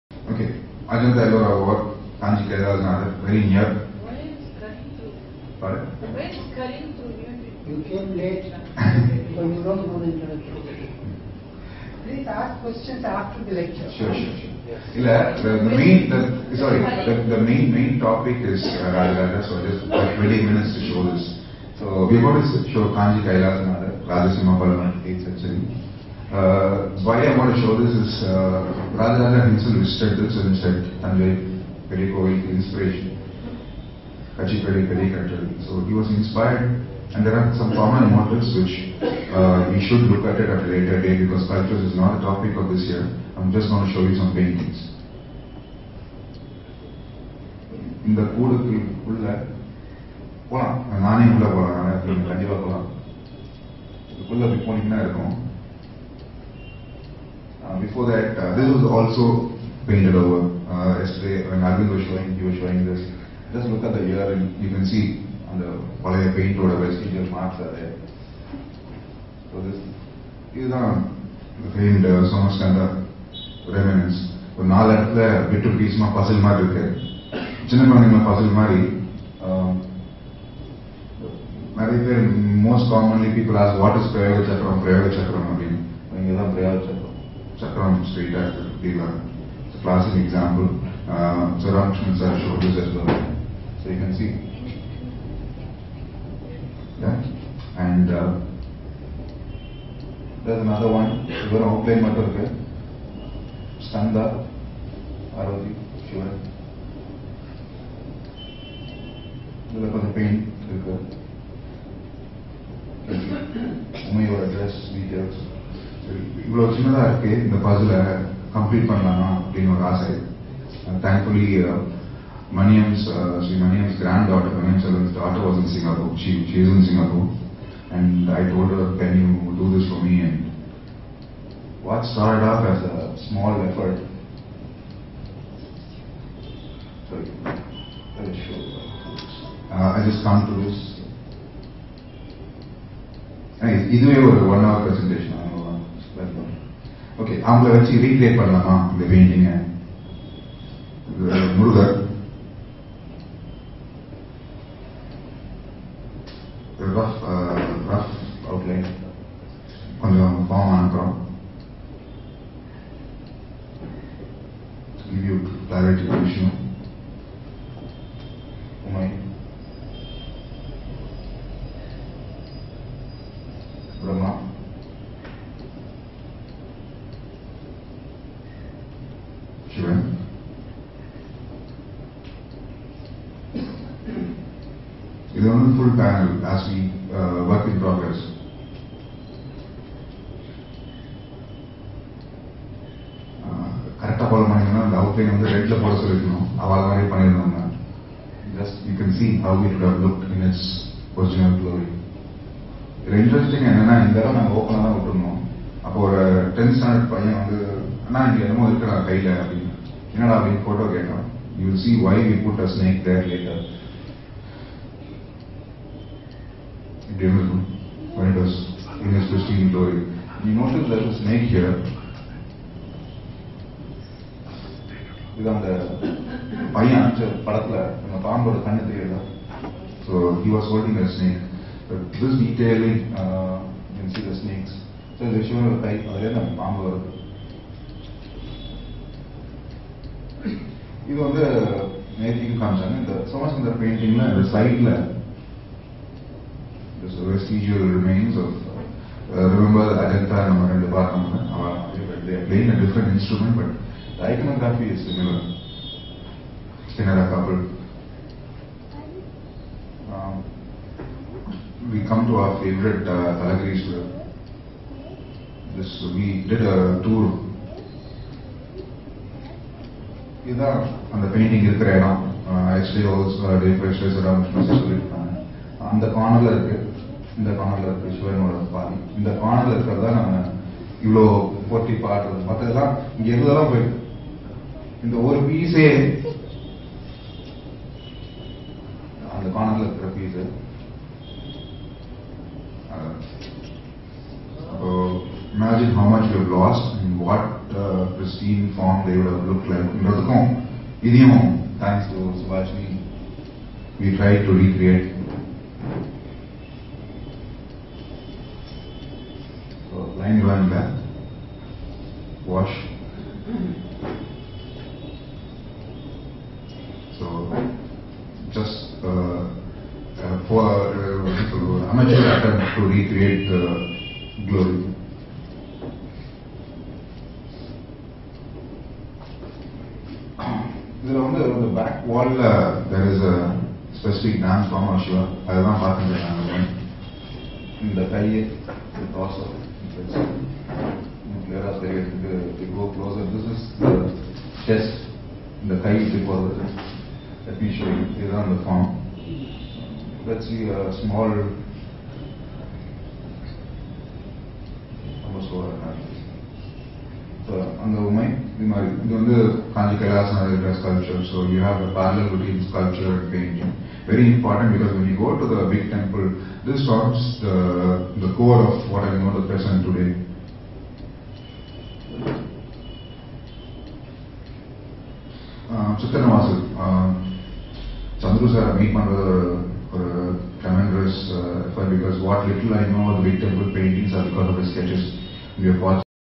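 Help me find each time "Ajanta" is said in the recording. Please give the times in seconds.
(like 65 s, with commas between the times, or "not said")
0 s, 249 s.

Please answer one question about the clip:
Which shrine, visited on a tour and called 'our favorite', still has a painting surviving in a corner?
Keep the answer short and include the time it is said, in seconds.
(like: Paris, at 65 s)
Talagrishwara, at 263 s.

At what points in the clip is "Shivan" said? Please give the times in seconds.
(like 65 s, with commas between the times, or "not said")
101 s, 106 s.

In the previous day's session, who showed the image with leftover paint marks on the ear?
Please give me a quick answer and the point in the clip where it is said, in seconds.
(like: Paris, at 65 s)
Alvin, at 61 s.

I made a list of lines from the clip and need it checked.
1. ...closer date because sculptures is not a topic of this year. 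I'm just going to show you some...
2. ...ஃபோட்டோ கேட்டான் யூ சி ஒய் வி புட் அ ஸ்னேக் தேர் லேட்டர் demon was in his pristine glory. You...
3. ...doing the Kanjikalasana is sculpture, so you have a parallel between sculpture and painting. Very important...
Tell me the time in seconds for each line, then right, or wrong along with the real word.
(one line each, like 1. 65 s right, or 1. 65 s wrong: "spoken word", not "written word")
1. 40 s wrong: "later", not "closer"
2. 210 s right
3. 359 s right.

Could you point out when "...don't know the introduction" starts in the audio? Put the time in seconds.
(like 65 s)
9 s.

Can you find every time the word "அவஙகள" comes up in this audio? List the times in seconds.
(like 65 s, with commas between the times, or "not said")
147 s.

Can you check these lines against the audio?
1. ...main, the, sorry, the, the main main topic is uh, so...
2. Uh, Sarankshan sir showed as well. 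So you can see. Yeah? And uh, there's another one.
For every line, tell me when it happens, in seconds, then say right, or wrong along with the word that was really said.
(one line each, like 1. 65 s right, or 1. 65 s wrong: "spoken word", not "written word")
1. 15 s right
2. 91 s right.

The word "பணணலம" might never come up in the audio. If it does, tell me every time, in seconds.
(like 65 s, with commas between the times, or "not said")
118 s, 148 s.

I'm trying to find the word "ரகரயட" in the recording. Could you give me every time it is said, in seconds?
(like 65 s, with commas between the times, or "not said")
148 s, 304 s.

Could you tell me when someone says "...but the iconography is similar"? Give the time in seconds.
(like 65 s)
253 s.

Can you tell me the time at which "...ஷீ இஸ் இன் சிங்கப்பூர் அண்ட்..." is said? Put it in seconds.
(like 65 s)
126 s.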